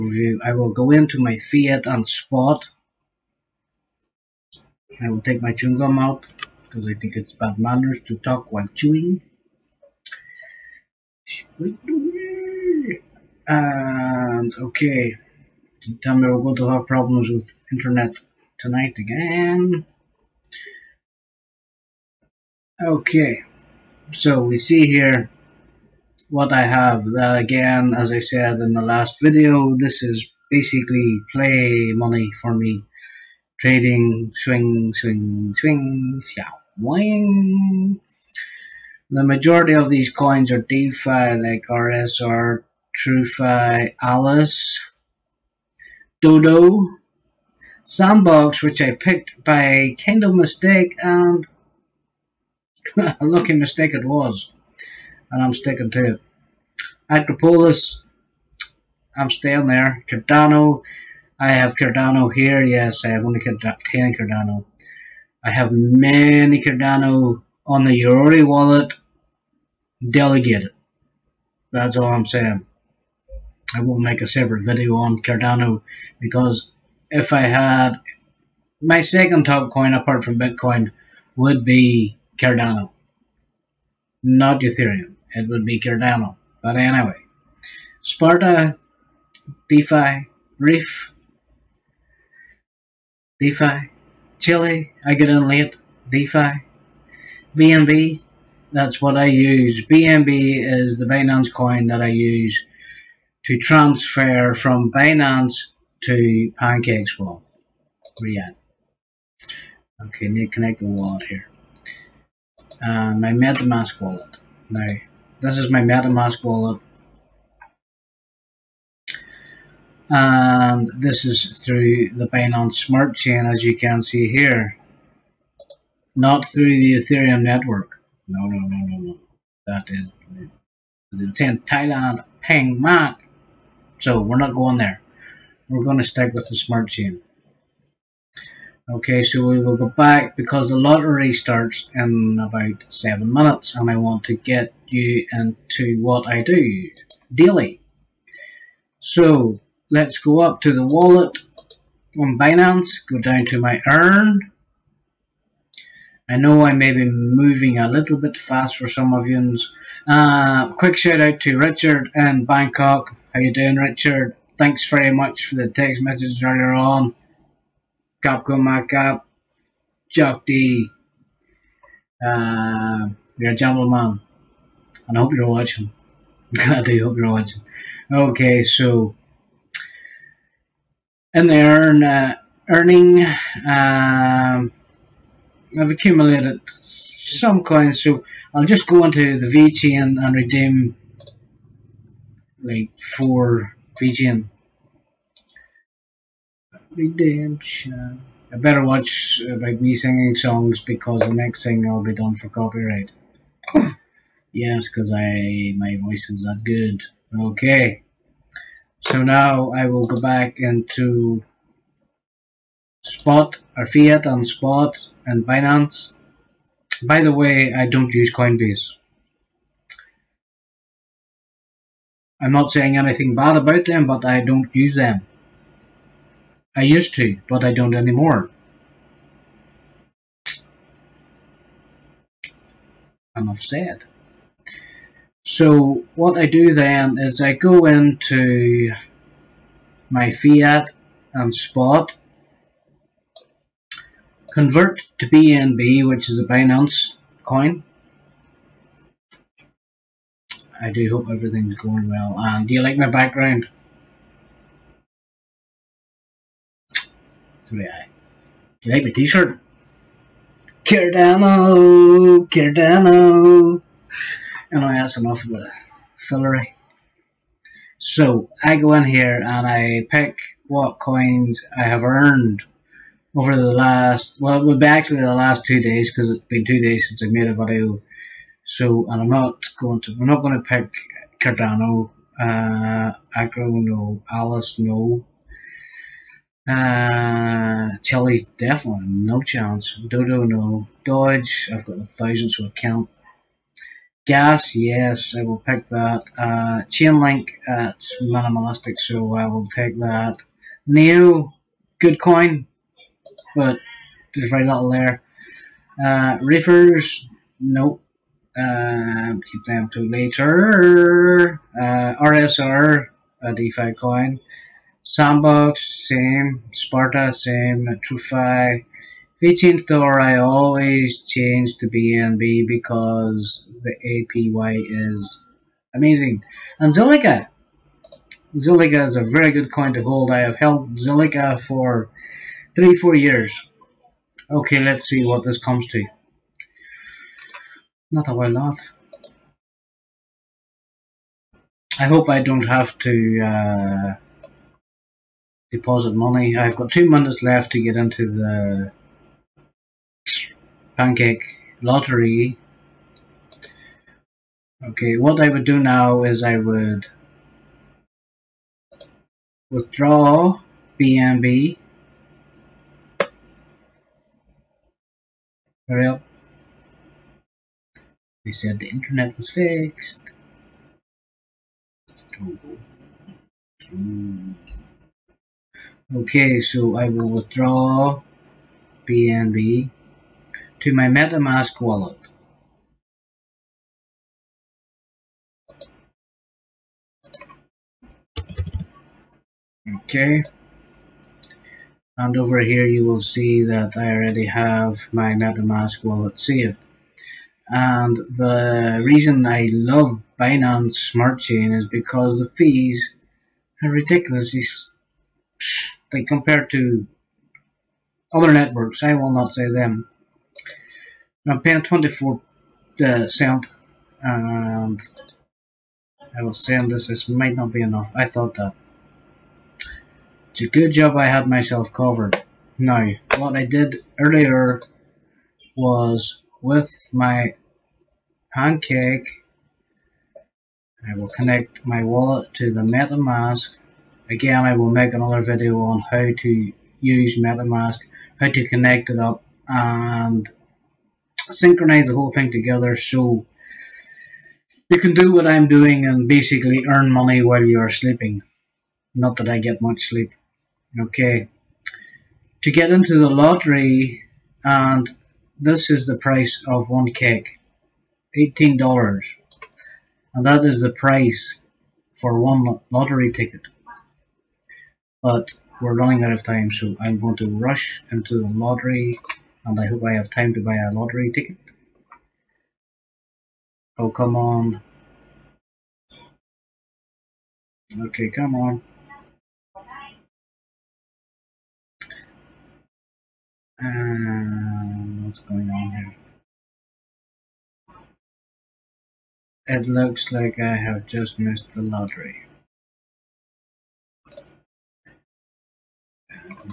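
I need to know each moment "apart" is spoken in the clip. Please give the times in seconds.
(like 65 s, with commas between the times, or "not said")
79 s.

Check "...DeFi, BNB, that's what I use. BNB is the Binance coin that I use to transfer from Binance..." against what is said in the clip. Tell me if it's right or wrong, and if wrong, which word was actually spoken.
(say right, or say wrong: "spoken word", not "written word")
right.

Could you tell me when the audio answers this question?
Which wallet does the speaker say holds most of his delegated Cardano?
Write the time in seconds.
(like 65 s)
68 s.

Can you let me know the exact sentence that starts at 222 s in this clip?
I'm not saying anything bad about them, but I don't use them.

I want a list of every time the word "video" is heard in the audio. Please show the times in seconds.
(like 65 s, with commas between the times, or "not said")
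29 s, 74 s, 277 s, 435 s.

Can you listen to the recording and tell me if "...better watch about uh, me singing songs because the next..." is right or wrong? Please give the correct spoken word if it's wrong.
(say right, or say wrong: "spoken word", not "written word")
right.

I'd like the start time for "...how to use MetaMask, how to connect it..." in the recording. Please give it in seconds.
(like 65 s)
436 s.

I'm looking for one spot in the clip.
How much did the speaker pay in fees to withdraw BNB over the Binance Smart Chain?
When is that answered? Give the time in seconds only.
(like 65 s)
411 s.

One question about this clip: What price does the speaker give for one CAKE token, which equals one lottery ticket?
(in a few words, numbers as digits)
$18.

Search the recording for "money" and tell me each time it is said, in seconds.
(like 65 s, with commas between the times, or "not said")
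31 s, 346 s, 447 s.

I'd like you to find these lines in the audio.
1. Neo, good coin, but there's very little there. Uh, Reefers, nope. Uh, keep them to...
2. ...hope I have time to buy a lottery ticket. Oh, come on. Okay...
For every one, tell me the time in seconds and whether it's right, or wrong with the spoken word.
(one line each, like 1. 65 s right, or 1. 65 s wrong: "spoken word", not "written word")
1. 300 s right
2. 469 s right.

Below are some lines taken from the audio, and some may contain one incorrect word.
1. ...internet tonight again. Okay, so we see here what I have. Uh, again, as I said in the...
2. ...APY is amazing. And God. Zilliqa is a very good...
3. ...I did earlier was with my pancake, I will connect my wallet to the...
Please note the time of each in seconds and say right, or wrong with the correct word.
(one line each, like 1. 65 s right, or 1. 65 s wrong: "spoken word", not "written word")
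1. 17 s right
2. 324 s wrong: "Zilliqa", not "God"
3. 423 s right.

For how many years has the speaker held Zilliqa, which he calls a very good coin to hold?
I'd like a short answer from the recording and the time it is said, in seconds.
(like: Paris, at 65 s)
3-4 years, at 332 s.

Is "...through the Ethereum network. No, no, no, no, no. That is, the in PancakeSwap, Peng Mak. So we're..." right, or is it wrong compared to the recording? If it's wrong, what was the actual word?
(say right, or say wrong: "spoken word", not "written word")
wrong: "Thailand", not "PancakeSwap".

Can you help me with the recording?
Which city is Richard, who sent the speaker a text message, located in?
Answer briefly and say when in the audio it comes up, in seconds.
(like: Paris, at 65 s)
Bangkok, at 162 s.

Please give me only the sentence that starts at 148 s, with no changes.
So let's go up to the wallet on Binance, go down to my earn.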